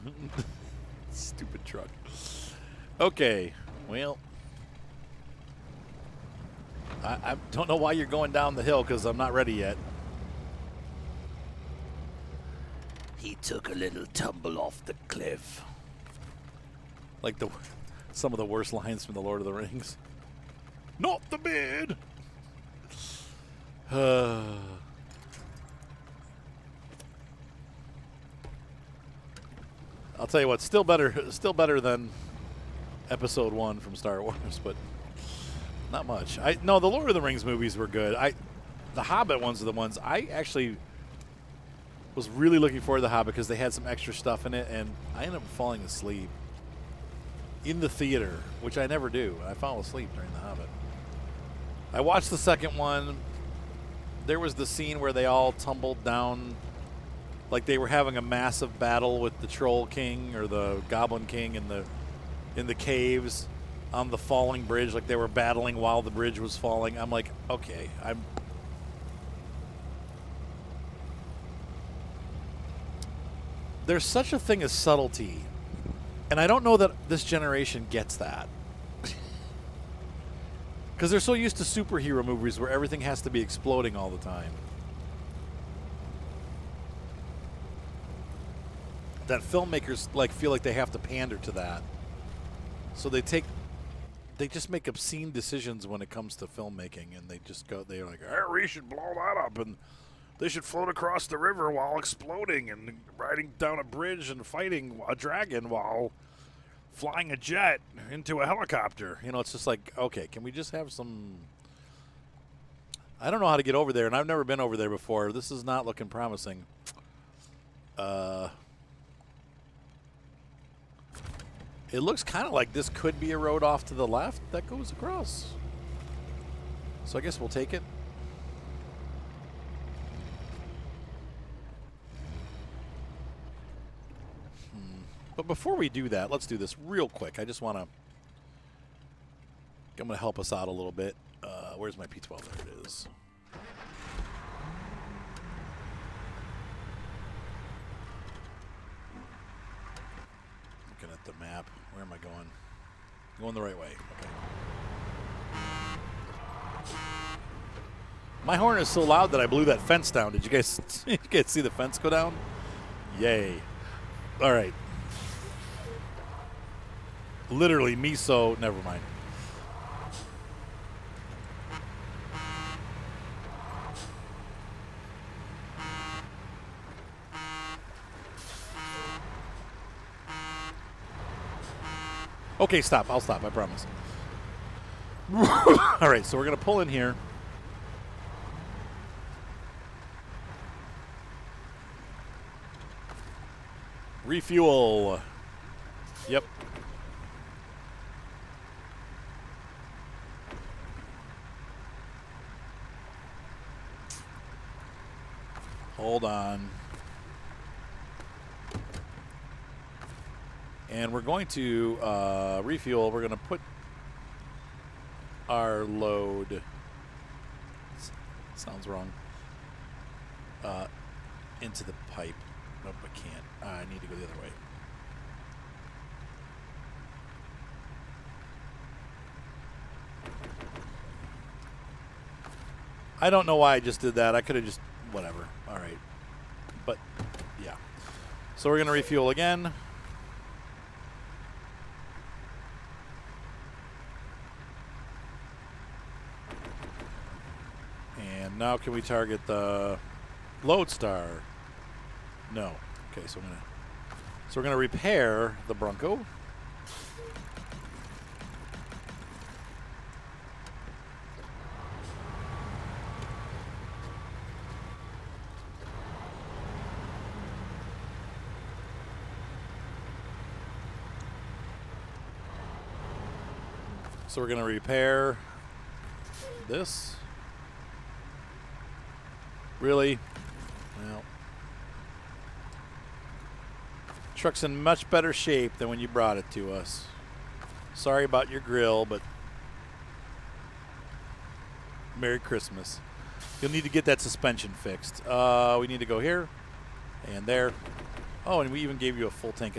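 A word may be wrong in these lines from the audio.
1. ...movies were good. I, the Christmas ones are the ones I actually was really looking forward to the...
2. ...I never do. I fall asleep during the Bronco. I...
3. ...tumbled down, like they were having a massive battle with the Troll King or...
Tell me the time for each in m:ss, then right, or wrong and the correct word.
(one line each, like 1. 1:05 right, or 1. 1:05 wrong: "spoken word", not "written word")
1. 0:37 wrong: "Hobbit", not "Christmas"
2. 0:48 wrong: "Hobbit", not "Bronco"
3. 0:55 right.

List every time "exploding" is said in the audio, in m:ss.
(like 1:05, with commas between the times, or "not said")
1:23, 1:41.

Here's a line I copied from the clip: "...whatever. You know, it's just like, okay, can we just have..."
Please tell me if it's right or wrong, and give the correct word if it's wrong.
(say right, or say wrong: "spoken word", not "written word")
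wrong: "helicopter", not "whatever".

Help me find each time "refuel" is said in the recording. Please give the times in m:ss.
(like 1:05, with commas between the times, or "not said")
3:14, 3:32, 3:58.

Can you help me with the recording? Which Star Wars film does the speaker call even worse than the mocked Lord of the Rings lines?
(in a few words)
Episode One.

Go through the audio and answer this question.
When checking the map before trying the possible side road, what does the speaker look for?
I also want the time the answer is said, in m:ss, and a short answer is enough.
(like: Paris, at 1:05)
P12, at 2:22.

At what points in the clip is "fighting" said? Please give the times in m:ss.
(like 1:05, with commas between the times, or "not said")
1:44.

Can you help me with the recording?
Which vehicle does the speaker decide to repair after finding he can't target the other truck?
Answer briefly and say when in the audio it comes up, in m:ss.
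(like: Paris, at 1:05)
Bronco, at 4:15.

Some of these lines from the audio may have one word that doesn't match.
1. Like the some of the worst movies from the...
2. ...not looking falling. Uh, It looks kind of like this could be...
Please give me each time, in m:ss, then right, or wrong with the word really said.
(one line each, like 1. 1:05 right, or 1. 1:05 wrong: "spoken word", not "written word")
1. 0:17 wrong: "lines", not "movies"
2. 1:55 wrong: "promising", not "falling".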